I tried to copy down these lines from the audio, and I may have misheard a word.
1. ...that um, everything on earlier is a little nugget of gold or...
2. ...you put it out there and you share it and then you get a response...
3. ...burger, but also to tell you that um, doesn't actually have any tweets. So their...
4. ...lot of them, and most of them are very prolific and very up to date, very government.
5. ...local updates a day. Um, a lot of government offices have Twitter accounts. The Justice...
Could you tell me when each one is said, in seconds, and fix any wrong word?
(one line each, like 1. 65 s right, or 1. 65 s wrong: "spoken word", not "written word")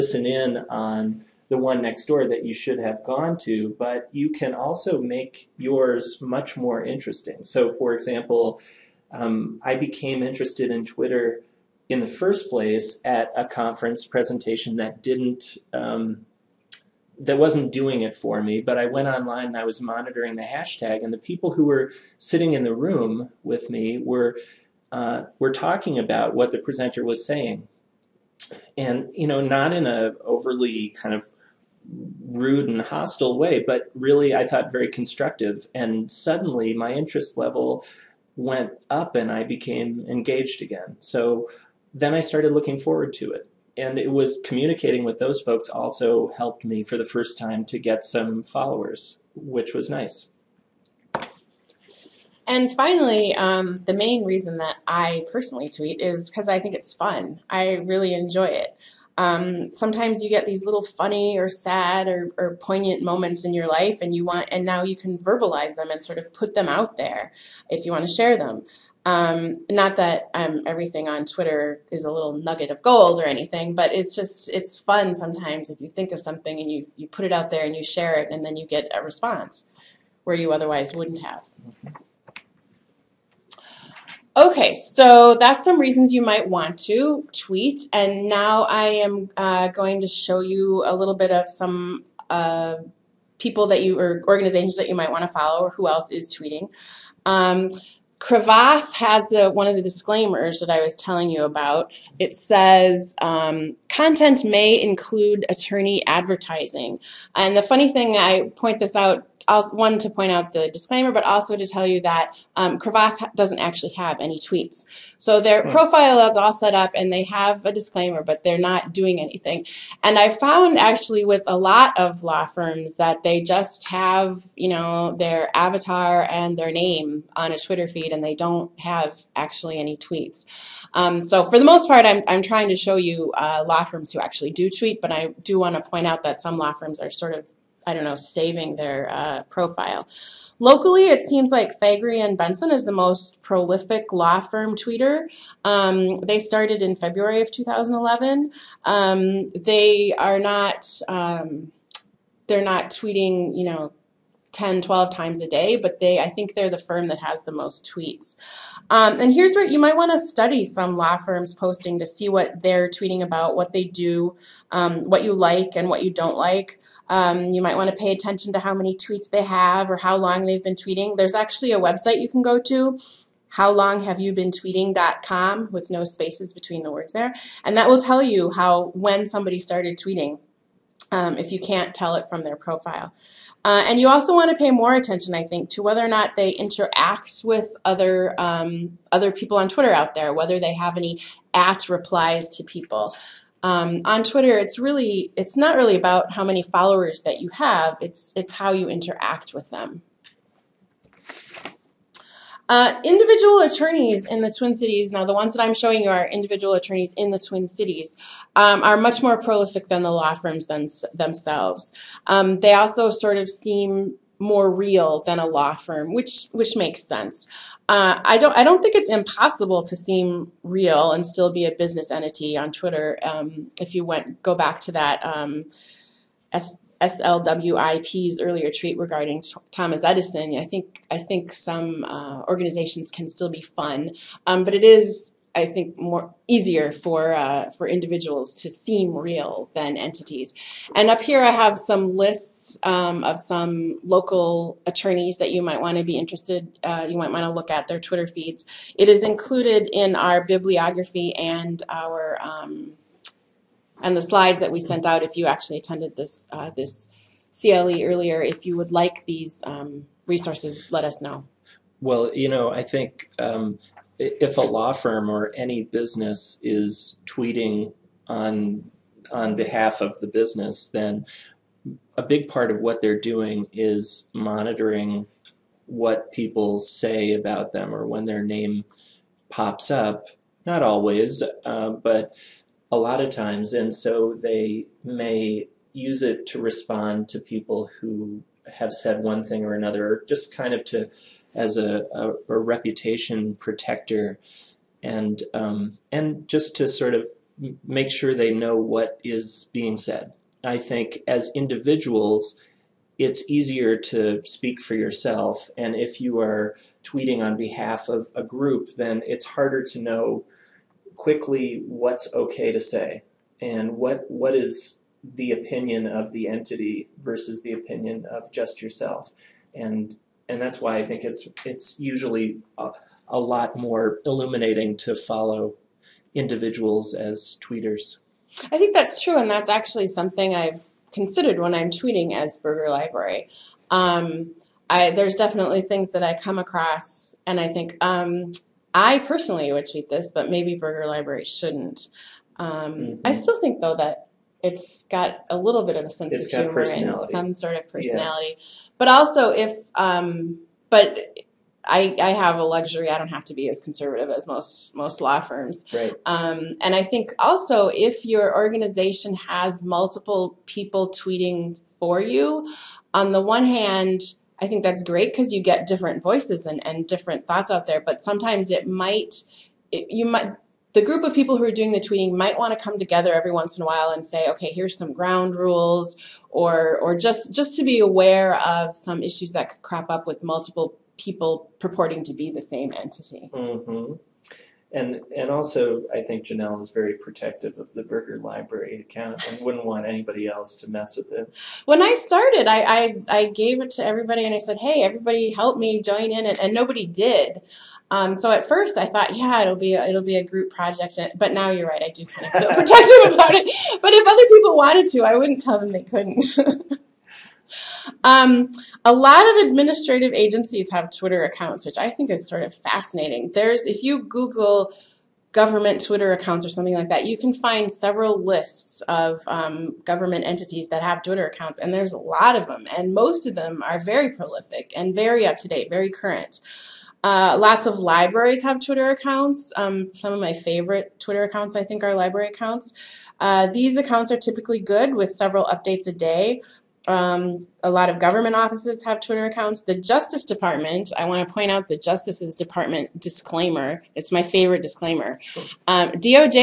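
1. 69 s wrong: "twitter", not "earlier"
2. 76 s right
3. 110 s wrong: "disclaimer", not "burger"
4. 422 s wrong: "current", not "government"
5. 435 s wrong: "several", not "local".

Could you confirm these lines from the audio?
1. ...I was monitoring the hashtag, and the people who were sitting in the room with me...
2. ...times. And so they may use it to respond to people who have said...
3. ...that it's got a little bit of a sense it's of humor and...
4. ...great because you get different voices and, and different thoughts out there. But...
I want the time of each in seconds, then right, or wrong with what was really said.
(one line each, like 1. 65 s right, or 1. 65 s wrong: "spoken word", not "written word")
1. 19 s right
2. 283 s right
3. 343 s right
4. 365 s right.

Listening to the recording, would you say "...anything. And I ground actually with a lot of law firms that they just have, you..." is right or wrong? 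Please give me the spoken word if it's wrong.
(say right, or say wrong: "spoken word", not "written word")
wrong: "found", not "ground".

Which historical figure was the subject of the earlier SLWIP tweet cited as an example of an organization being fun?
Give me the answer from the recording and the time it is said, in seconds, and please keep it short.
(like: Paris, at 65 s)
Thomas Edison, at 229 s.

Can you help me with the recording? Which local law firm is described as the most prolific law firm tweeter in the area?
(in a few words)
Faegre and Benson.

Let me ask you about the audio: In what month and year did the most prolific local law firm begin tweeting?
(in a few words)
February 2011.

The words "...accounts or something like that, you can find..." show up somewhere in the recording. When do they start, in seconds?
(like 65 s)
416 s.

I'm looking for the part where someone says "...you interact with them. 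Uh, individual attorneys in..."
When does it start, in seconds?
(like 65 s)
198 s.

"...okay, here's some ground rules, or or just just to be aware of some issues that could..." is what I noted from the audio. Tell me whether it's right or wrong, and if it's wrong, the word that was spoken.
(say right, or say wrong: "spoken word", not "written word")
right.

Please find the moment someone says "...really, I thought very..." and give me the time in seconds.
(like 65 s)
33 s.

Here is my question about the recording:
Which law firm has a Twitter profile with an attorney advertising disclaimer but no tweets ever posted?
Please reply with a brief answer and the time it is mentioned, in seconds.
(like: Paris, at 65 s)
Cravath, at 98 s.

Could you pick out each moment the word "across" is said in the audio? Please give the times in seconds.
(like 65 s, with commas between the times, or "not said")
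336 s.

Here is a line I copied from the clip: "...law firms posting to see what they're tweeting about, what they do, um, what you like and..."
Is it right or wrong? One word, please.
right.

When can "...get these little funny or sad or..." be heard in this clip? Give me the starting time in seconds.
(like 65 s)
60 s.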